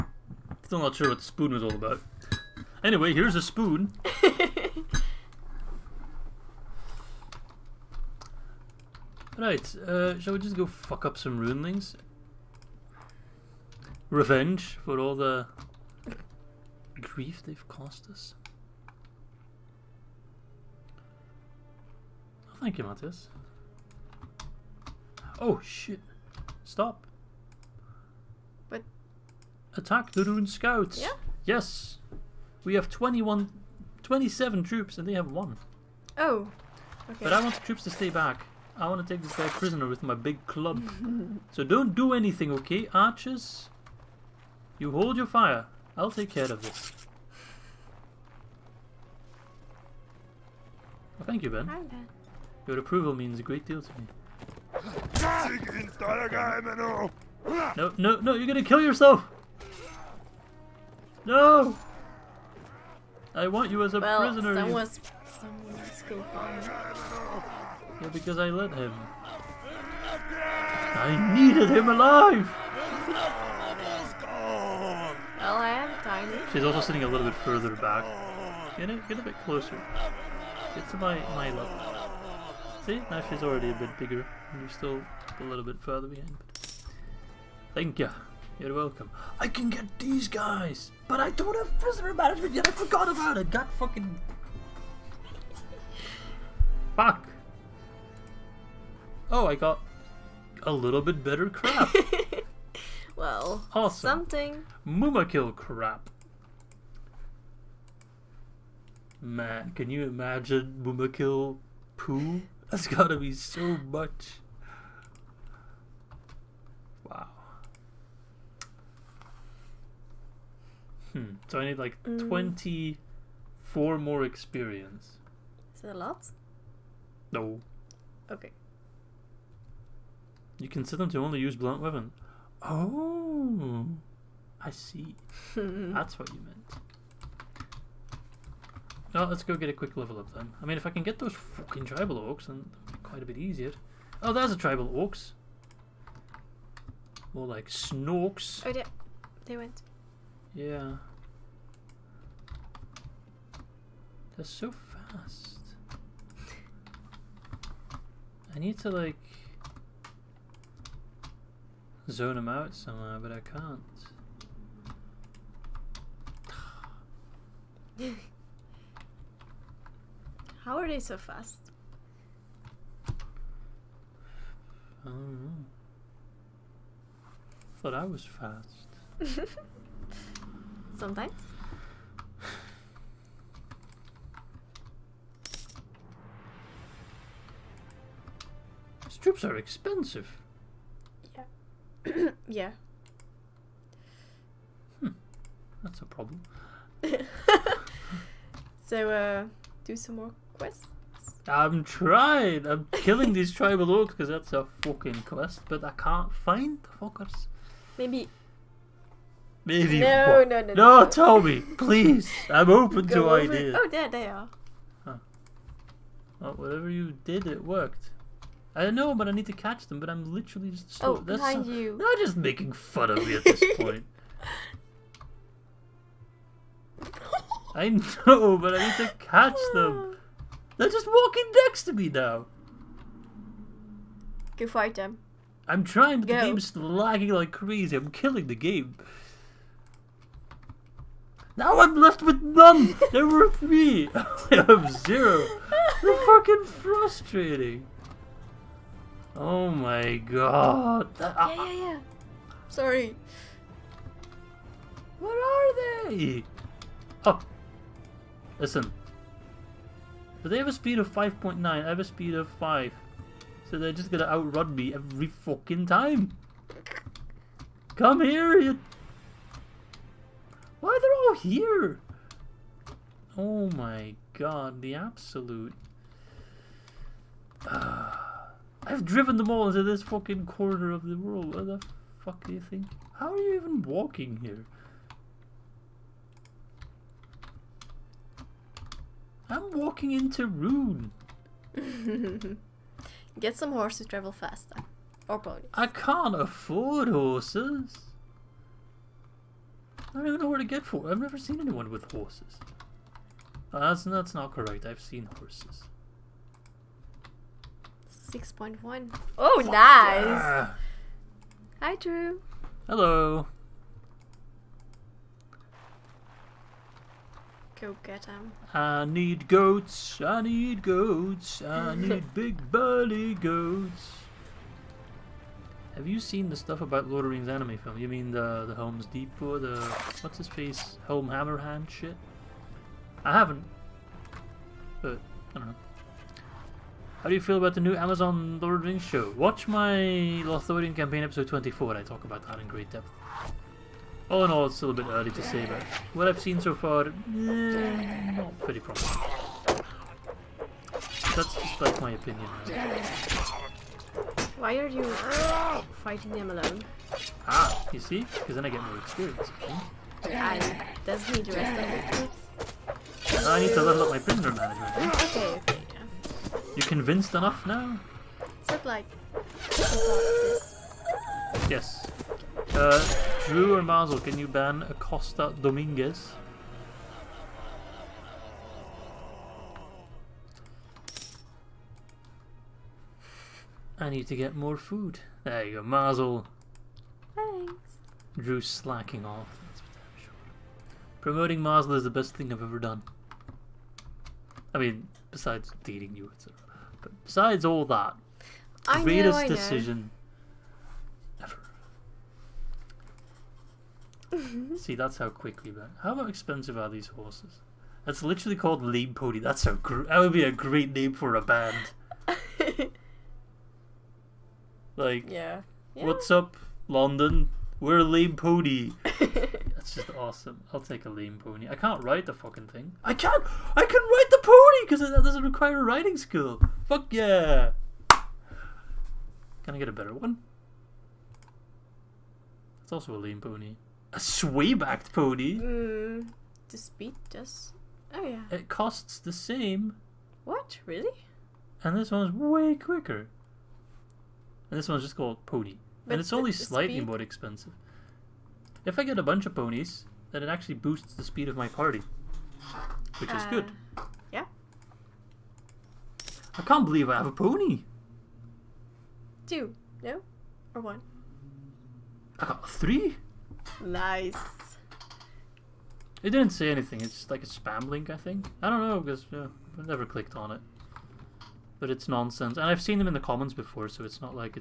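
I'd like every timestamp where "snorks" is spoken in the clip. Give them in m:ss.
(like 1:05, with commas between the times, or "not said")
2:27.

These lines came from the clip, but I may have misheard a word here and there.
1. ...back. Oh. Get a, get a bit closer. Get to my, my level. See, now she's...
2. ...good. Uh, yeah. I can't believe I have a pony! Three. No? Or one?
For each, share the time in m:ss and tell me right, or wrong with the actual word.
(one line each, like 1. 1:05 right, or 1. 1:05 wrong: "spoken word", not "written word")
1. 1:17 right
2. 7:33 wrong: "Two", not "Three".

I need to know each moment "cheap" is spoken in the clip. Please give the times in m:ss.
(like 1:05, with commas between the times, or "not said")
not said.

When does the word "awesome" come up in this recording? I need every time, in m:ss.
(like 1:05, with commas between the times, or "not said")
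1:43, 7:00.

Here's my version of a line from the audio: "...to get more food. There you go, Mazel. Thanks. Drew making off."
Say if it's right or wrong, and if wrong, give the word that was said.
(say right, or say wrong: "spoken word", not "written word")
wrong: "slacking", not "making".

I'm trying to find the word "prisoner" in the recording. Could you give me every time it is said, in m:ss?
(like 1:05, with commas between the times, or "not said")
0:39, 1:04, 1:31, 6:04.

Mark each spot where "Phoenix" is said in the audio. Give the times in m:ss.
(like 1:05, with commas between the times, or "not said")
not said.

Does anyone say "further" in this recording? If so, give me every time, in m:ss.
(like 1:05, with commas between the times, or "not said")
1:17, 1:25.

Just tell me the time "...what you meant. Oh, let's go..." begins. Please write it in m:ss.
2:16.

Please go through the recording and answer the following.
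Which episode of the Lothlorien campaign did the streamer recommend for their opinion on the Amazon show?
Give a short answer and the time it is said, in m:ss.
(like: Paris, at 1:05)
24, at 5:41.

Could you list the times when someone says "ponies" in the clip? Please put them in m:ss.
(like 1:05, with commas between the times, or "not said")
4:55, 7:29.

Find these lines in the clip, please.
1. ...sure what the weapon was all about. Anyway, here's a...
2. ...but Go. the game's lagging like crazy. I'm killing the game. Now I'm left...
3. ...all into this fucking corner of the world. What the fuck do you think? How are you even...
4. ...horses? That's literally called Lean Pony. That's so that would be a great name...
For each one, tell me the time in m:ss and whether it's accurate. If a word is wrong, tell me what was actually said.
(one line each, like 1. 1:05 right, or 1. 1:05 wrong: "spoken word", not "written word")
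1. 0:00 wrong: "spoon", not "weapon"
2. 3:56 right
3. 4:39 right
4. 6:47 right.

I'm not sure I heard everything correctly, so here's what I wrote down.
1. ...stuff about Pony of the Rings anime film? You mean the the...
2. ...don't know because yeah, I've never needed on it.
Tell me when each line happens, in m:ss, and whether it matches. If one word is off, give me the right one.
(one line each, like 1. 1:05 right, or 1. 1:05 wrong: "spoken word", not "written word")
1. 5:26 wrong: "Lord", not "Pony"
2. 7:48 wrong: "clicked", not "needed".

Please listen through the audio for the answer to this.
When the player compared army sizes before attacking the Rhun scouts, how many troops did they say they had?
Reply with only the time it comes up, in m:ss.
0:34.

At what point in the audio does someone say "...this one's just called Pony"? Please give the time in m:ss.
7:24.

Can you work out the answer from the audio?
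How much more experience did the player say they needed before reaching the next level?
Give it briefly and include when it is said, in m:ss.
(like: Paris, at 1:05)
24, at 2:02.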